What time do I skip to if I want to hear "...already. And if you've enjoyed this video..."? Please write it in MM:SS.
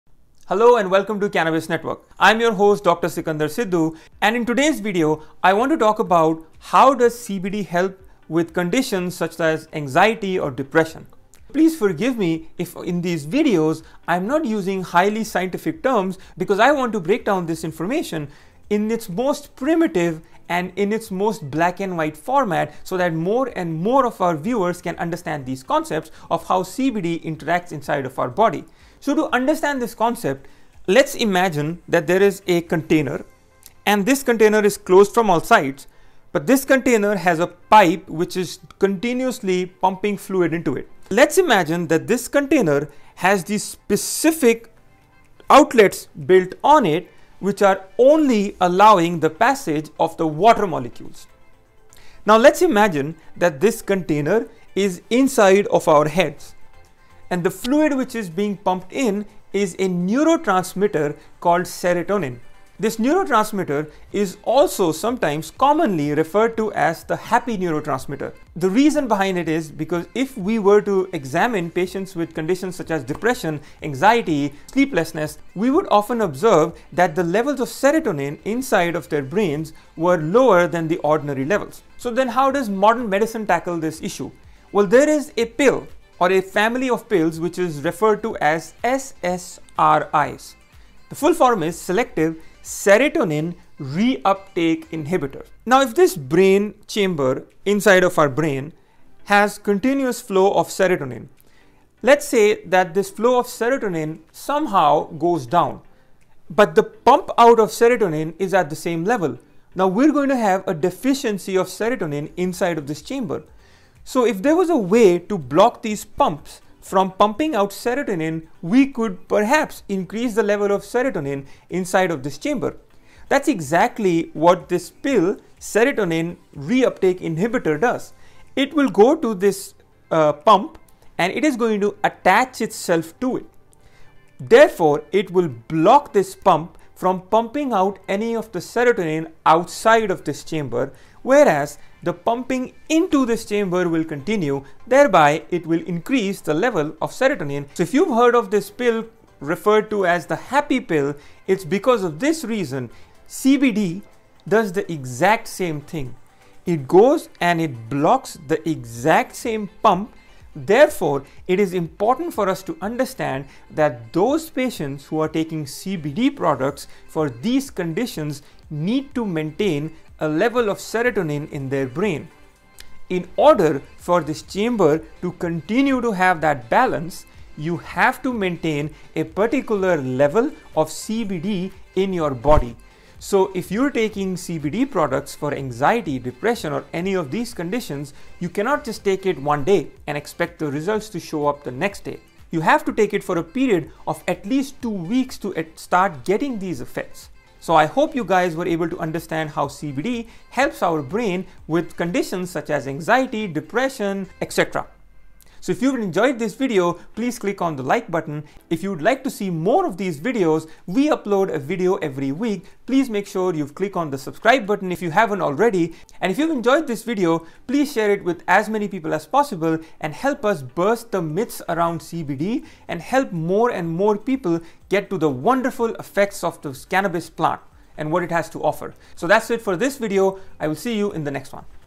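03:35.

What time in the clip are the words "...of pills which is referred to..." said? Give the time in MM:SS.
01:26.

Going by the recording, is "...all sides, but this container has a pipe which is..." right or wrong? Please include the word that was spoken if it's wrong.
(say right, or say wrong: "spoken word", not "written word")
right.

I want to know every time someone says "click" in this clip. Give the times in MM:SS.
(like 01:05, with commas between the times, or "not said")
03:27, 03:33.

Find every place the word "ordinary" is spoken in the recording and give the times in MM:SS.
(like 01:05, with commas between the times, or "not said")
01:20.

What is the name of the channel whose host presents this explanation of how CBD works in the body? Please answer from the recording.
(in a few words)
Cannabis Network.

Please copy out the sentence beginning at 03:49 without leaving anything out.
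So that's it for this video.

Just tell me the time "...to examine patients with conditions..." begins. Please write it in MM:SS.
01:10.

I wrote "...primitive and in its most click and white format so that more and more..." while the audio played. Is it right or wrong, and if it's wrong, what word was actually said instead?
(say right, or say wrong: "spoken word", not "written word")
wrong: "black", not "click".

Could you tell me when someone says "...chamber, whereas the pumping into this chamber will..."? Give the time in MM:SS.
02:20.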